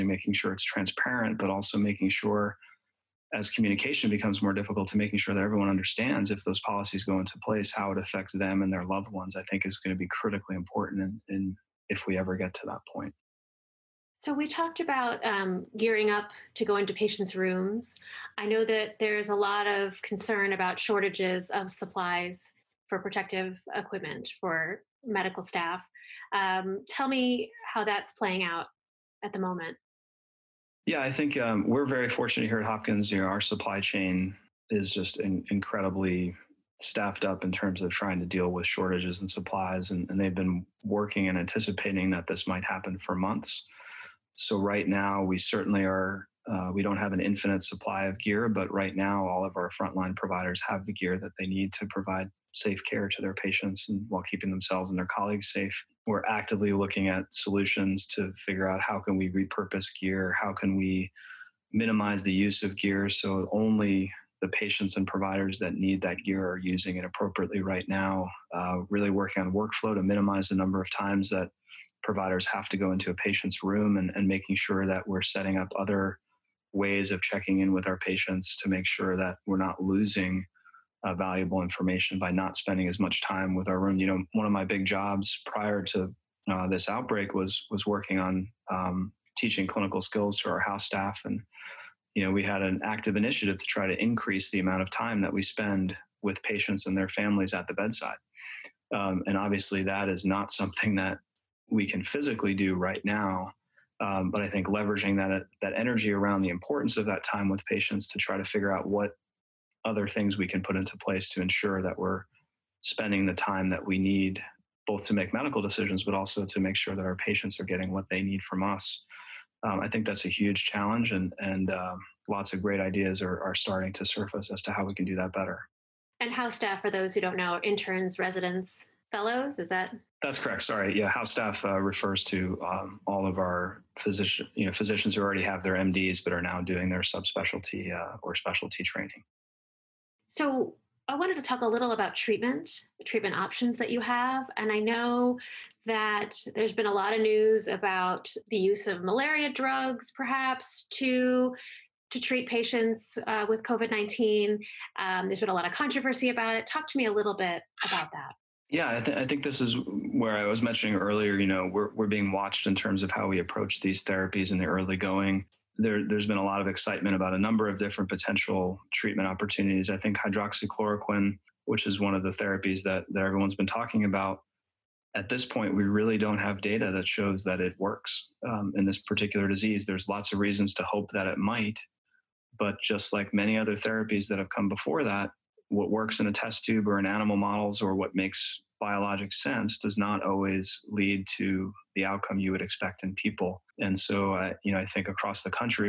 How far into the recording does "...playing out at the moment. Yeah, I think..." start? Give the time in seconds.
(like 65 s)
28 s.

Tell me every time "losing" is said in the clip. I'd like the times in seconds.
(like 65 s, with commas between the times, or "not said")
79 s.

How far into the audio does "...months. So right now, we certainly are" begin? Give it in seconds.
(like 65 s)
43 s.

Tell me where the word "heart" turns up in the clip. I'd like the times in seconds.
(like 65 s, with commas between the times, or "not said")
not said.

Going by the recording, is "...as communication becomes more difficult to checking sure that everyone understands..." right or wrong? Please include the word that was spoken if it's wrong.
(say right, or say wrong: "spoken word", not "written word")
wrong: "making", not "checking".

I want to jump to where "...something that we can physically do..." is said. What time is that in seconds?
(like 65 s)
100 s.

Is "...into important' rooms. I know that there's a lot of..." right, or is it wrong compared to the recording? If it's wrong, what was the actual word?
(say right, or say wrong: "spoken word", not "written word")
wrong: "patients", not "important".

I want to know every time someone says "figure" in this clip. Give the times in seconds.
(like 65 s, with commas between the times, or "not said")
58 s, 108 s.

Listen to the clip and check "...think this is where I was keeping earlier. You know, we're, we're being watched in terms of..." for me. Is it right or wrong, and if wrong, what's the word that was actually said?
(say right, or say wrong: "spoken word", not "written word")
wrong: "mentioning", not "keeping".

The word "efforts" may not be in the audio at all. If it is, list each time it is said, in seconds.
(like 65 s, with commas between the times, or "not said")
not said.